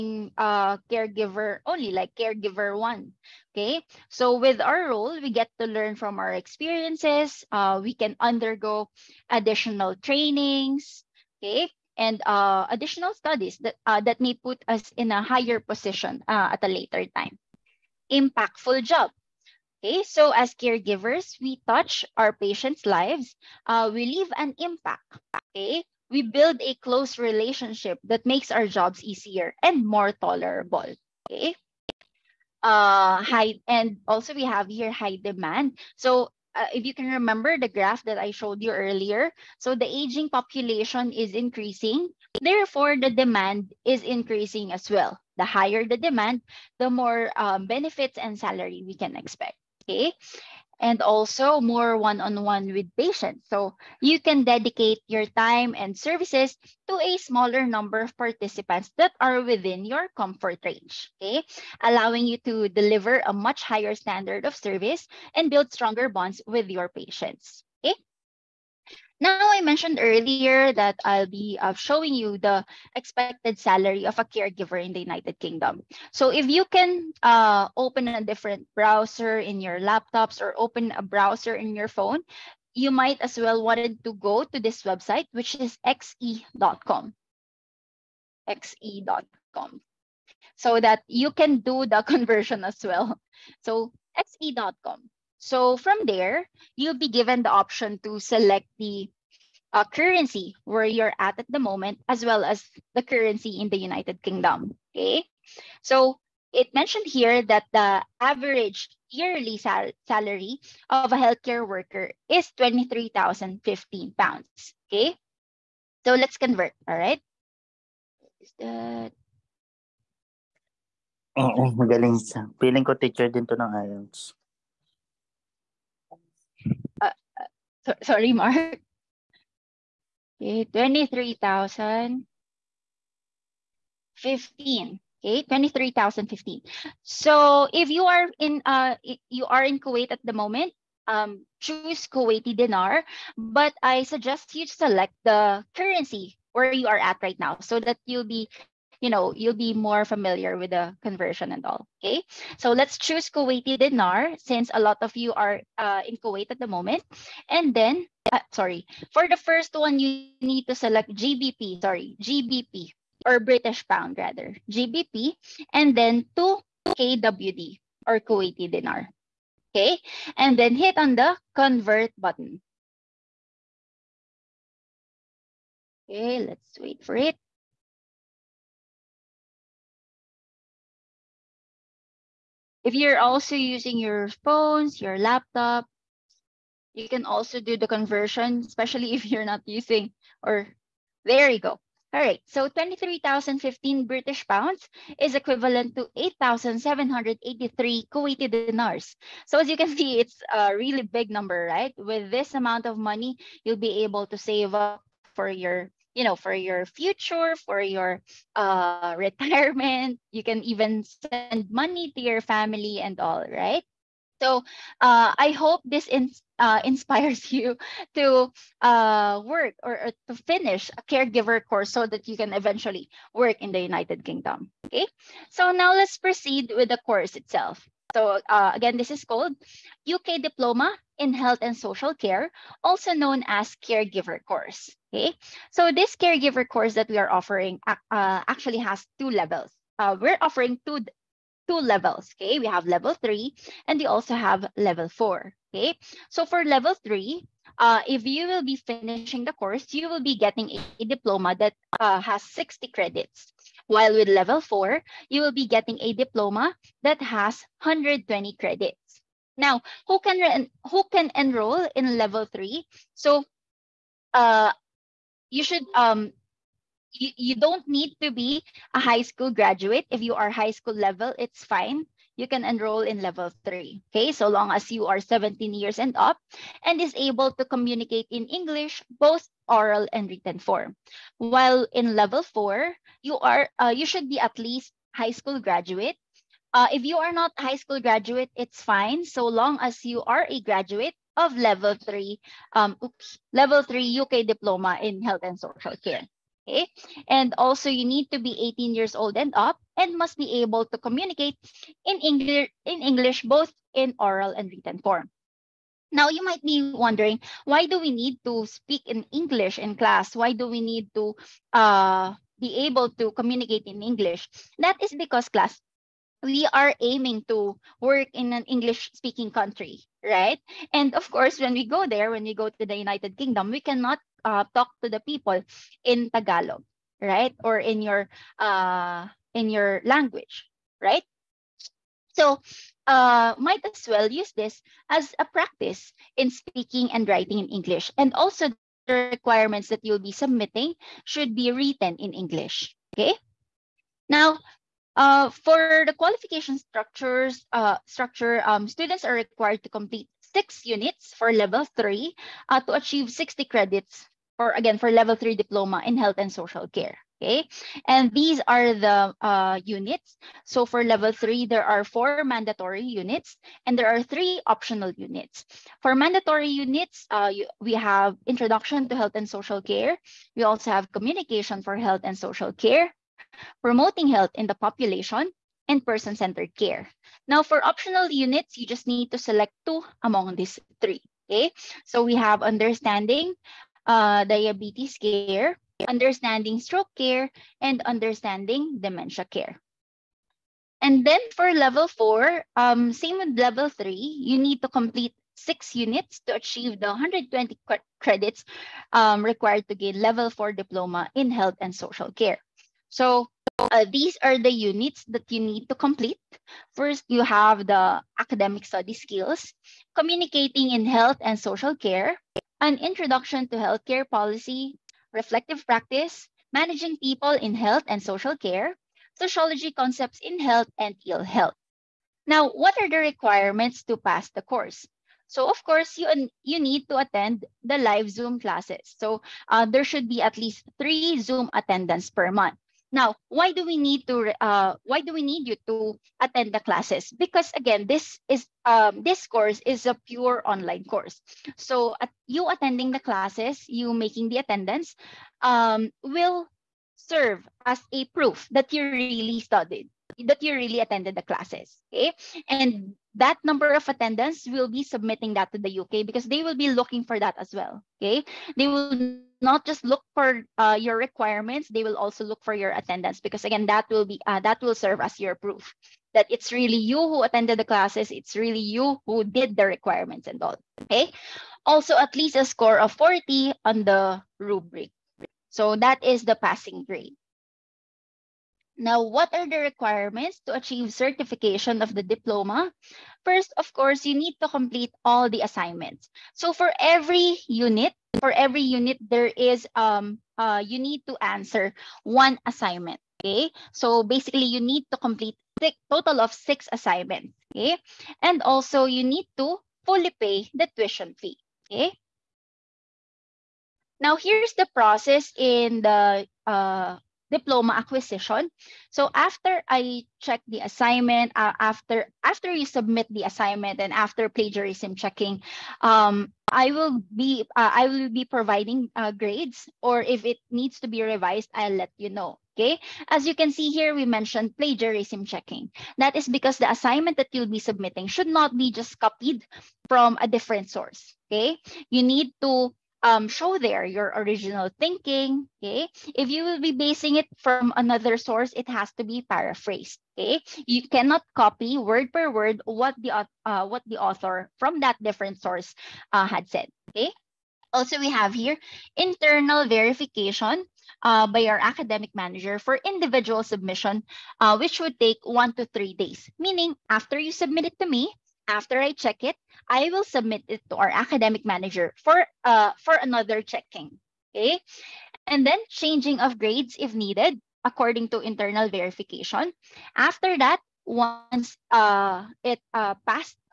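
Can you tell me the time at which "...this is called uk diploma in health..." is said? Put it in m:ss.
3:48.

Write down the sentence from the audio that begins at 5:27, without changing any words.
Or in your uh, in your language, right?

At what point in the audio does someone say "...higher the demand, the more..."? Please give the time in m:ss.
0:45.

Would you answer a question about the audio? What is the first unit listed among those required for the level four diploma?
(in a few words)
Academic study skills.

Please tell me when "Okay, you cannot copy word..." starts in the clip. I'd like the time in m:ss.
9:00.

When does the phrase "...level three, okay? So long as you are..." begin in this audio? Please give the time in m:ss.
4:33.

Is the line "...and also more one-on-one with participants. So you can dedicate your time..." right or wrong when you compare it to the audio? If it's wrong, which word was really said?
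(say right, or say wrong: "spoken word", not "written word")
wrong: "patients", not "participants".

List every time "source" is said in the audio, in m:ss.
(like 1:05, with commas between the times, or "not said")
8:50, 8:58, 9:05.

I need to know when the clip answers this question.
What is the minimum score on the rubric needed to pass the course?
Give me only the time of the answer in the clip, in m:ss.
7:53.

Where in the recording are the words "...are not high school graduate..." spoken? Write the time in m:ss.
4:47.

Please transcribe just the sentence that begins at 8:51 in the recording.
Okay, you need to um, show there your original thinking.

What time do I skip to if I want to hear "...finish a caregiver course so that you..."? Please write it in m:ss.
3:40.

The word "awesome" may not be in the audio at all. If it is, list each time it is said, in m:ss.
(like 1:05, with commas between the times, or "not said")
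not said.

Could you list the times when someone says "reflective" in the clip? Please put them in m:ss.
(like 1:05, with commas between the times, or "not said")
6:55.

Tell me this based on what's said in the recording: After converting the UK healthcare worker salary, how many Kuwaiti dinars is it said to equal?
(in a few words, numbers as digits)
8,783.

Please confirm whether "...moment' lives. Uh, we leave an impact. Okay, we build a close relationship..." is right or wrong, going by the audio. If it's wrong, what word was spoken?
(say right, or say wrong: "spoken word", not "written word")
wrong: "patients", not "moment".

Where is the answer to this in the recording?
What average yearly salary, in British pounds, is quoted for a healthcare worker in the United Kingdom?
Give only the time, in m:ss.
1:52.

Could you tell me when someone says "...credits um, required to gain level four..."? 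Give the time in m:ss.
6:38.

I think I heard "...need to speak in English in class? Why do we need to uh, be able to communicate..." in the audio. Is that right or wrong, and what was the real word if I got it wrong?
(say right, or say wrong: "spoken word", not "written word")
right.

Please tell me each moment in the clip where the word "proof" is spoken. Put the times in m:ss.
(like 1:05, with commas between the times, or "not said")
7:28, 7:45.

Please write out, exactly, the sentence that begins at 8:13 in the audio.
Okay, so basically you need to complete six, total of six assignments.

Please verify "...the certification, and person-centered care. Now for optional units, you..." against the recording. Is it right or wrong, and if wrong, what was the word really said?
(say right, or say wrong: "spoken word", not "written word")
wrong: "population", not "certification".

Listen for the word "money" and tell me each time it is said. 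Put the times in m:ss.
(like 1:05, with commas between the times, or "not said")
3:22, 3:31.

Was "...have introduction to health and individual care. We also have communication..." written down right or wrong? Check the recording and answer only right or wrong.
wrong.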